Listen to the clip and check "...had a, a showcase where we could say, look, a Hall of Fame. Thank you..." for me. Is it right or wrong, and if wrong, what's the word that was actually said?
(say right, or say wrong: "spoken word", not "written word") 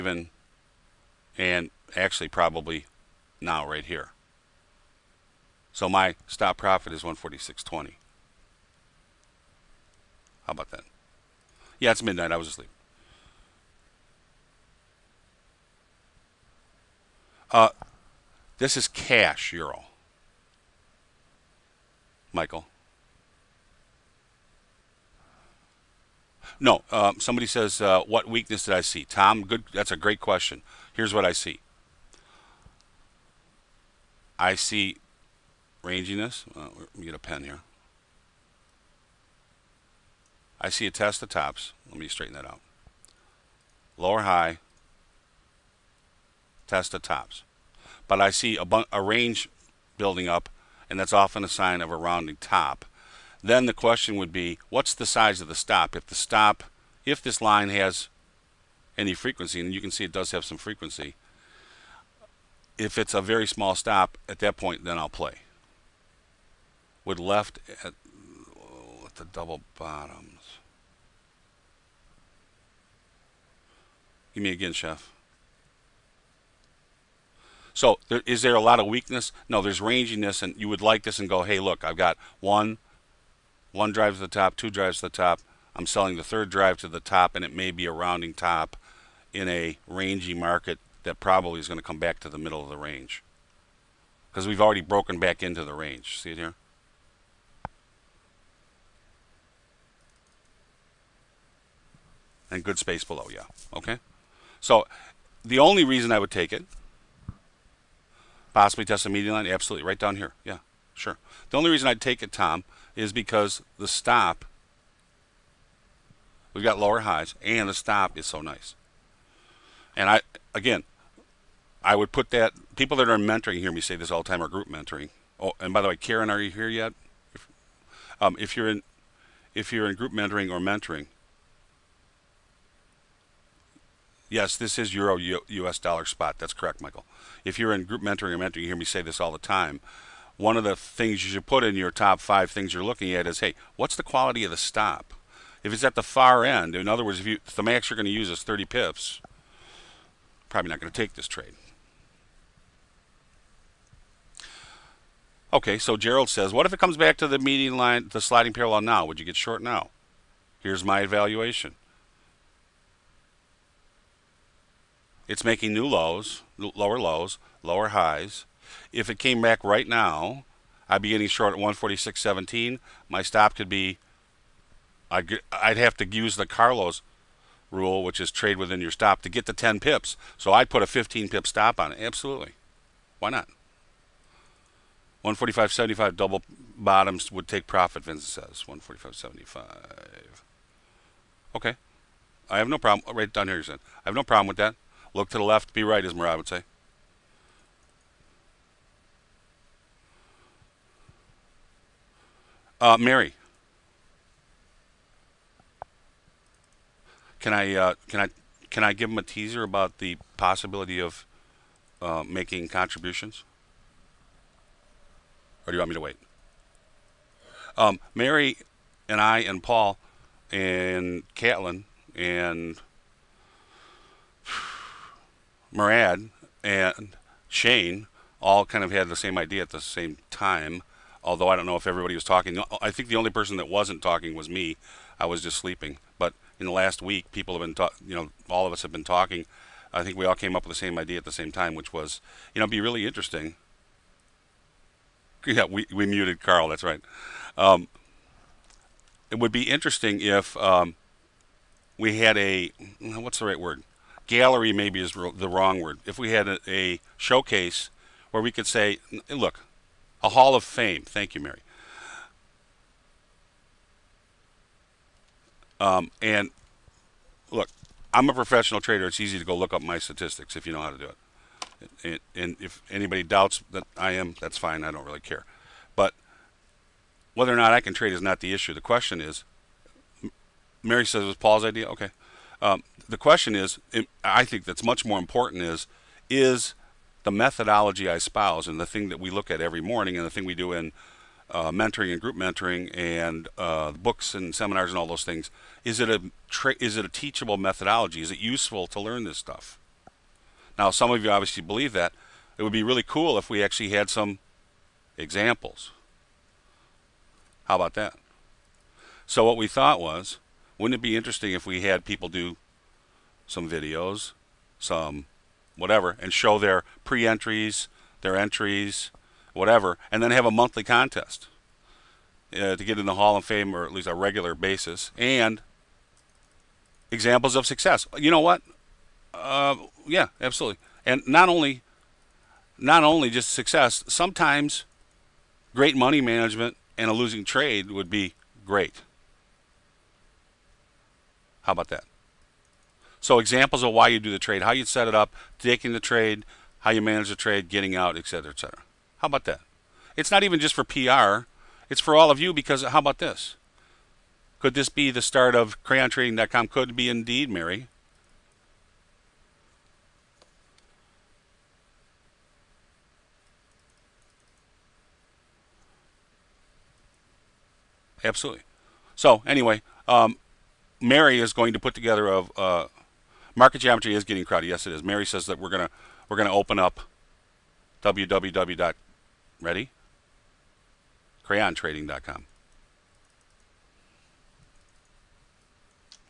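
right.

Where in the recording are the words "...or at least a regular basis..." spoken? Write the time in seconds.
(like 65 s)
323 s.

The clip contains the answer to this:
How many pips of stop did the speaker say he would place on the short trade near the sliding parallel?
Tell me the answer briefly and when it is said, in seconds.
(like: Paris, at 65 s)
15, at 180 s.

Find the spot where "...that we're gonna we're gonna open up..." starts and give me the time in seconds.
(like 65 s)
375 s.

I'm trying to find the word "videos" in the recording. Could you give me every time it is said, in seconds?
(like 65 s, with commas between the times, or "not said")
313 s.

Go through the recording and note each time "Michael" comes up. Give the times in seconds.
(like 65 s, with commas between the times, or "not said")
22 s, 136 s.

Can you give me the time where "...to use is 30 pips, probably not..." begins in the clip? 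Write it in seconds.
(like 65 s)
148 s.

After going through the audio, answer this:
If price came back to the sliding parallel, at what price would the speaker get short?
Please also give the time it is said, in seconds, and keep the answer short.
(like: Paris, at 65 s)
146.17, at 171 s.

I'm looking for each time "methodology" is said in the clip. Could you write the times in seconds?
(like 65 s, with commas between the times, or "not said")
287 s, 297 s.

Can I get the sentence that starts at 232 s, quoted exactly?
I think the only person that wasn't talking was me.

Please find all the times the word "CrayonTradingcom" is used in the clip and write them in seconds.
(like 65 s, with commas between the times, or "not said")
355 s, 381 s.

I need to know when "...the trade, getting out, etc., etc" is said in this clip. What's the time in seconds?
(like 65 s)
347 s.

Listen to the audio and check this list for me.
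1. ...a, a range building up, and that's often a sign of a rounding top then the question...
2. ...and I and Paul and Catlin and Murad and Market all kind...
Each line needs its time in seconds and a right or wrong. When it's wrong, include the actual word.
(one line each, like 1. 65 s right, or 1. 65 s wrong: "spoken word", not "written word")
1. 48 s right
2. 219 s wrong: "Shane", not "Market".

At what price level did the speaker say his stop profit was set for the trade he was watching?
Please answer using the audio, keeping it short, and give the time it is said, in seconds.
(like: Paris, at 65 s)
146.20, at 7 s.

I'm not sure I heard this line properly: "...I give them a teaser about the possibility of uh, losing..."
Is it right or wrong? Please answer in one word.
wrong.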